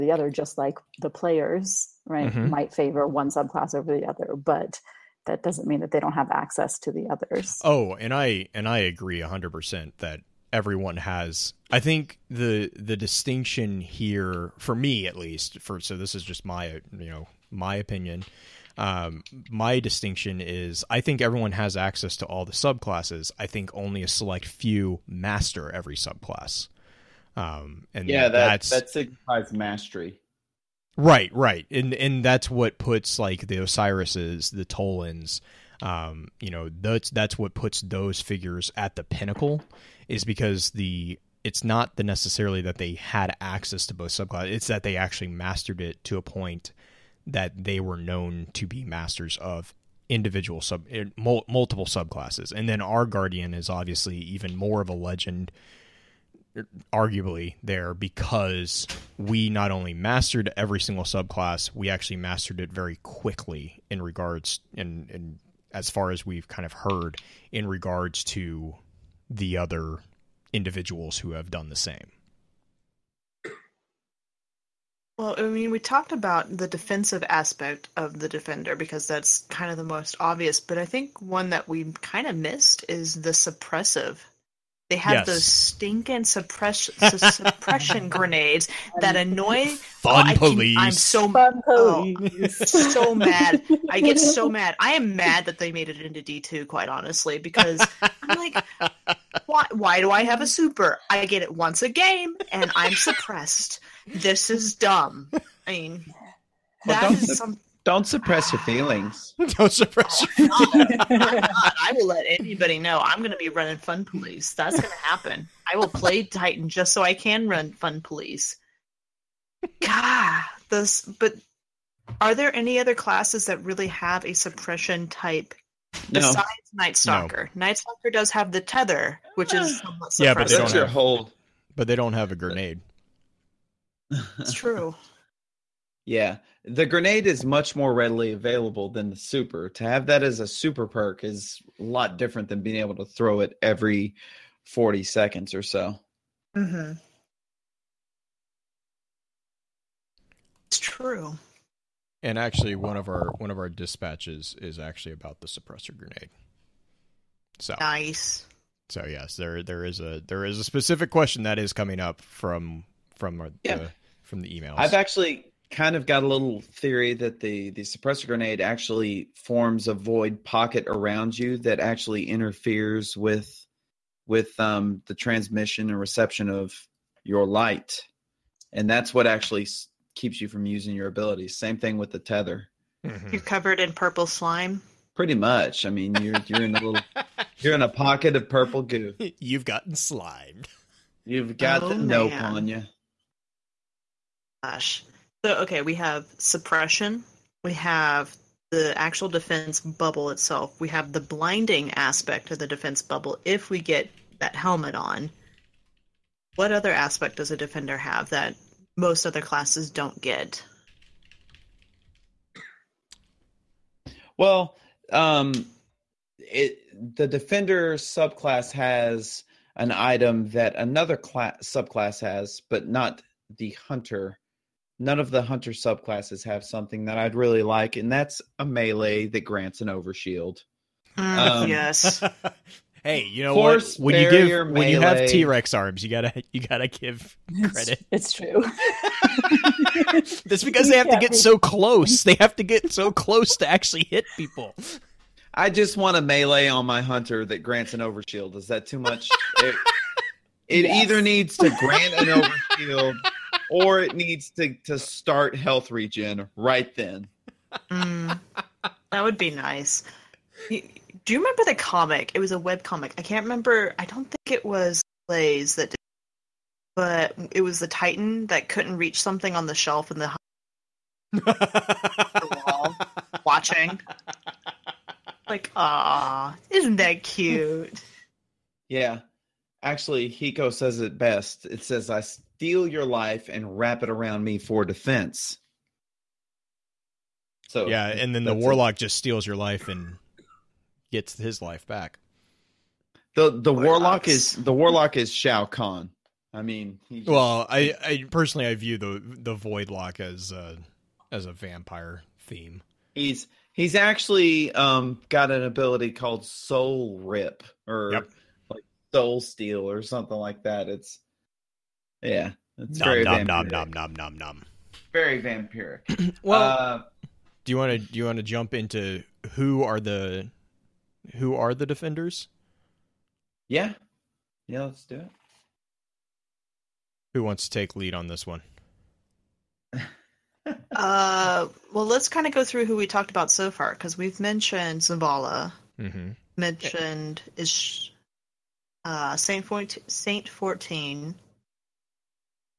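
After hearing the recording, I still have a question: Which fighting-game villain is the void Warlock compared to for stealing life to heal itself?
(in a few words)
Shao Kahn.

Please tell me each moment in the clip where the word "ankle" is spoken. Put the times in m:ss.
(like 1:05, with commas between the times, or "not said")
not said.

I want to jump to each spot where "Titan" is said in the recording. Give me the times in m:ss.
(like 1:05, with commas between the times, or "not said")
1:56, 4:27.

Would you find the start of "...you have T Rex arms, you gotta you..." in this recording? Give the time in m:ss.
3:54.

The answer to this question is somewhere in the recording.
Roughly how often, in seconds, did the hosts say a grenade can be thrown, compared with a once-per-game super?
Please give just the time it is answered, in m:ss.
2:24.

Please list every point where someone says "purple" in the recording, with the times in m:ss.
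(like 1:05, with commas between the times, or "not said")
3:03, 3:08.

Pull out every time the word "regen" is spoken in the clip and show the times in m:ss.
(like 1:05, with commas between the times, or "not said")
4:15.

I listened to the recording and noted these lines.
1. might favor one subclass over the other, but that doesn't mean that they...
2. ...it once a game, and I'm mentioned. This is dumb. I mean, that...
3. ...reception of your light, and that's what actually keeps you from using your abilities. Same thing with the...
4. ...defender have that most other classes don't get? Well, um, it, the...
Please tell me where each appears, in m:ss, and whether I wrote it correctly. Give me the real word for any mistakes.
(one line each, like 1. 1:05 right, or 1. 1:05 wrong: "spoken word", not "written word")
1. 0:02 right
2. 1:41 wrong: "suppressed", not "mentioned"
3. 2:55 right
4. 3:27 right.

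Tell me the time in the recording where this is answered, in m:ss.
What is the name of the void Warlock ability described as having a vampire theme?
5:06.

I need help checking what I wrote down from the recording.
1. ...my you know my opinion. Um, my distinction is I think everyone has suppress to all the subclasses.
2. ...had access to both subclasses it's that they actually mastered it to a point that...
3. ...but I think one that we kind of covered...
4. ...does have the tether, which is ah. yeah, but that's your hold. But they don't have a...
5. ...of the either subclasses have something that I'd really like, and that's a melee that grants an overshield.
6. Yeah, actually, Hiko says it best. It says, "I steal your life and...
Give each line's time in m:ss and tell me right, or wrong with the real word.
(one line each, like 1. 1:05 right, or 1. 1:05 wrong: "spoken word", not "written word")
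1. 0:16 wrong: "access", not "suppress"
2. 0:42 right
3. 1:20 wrong: "missed", not "covered"
4. 2:08 right
5. 3:45 wrong: "hunter", not "either"
6. 4:38 right.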